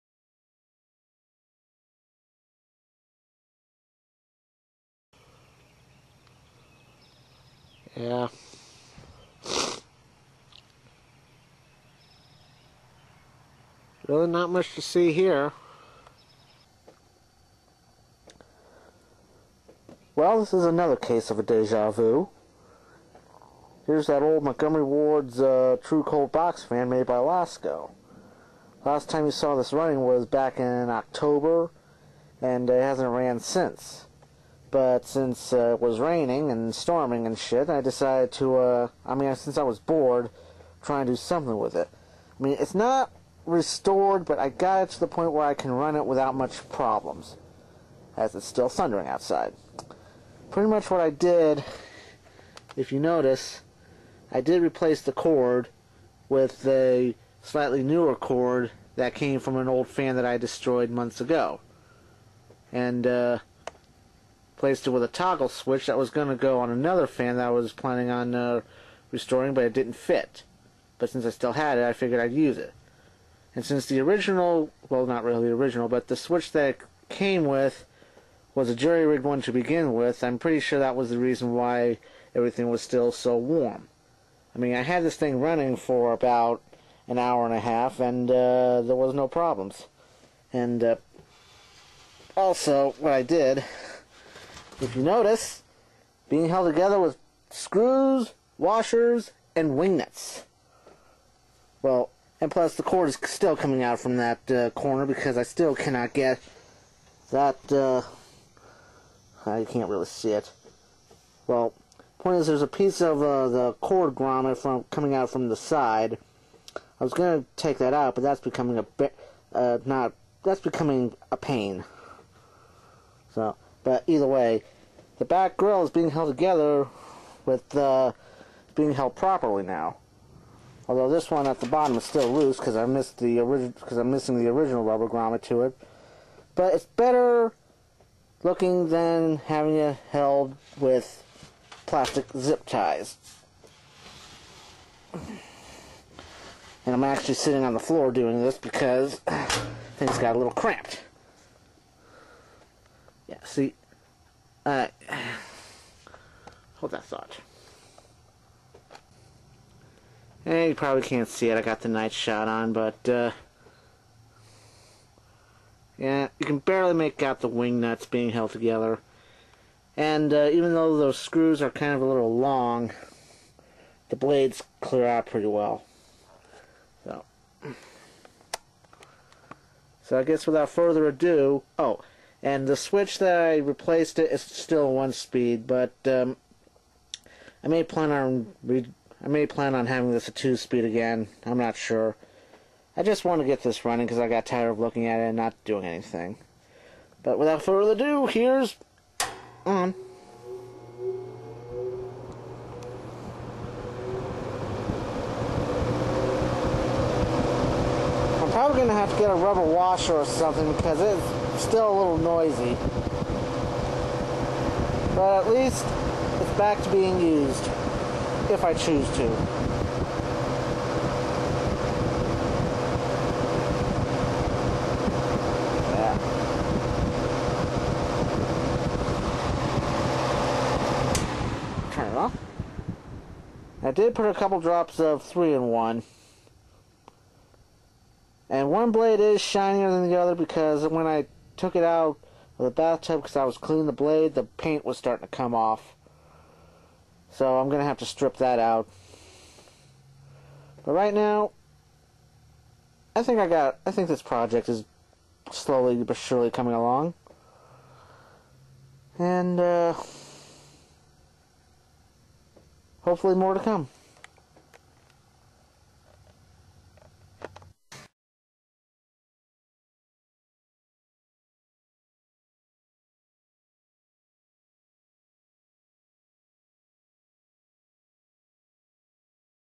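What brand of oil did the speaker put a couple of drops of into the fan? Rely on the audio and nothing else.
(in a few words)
3 in 1.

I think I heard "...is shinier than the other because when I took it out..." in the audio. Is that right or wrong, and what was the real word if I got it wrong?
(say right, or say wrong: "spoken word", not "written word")
right.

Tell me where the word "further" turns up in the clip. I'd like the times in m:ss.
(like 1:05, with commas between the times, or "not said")
3:00, 3:17.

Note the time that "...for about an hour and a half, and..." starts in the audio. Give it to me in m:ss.
1:25.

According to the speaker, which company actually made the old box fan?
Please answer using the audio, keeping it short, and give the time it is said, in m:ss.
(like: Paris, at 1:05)
Lasko, at 0:27.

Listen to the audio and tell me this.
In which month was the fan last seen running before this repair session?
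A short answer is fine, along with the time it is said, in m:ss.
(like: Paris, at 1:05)
October, at 0:30.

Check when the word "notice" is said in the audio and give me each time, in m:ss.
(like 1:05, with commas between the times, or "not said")
0:53, 1:35.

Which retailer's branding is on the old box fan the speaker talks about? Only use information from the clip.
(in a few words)
Montgomery Ward's.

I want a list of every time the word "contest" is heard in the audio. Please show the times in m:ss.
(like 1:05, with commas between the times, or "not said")
not said.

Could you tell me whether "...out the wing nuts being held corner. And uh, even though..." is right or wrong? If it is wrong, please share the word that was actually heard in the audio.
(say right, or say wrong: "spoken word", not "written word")
wrong: "together", not "corner".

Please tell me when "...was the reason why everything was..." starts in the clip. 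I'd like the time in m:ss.
1:20.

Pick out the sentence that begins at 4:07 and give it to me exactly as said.
So I'm going to have to strip that out.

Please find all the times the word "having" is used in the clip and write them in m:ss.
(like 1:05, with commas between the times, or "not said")
2:19, 3:09.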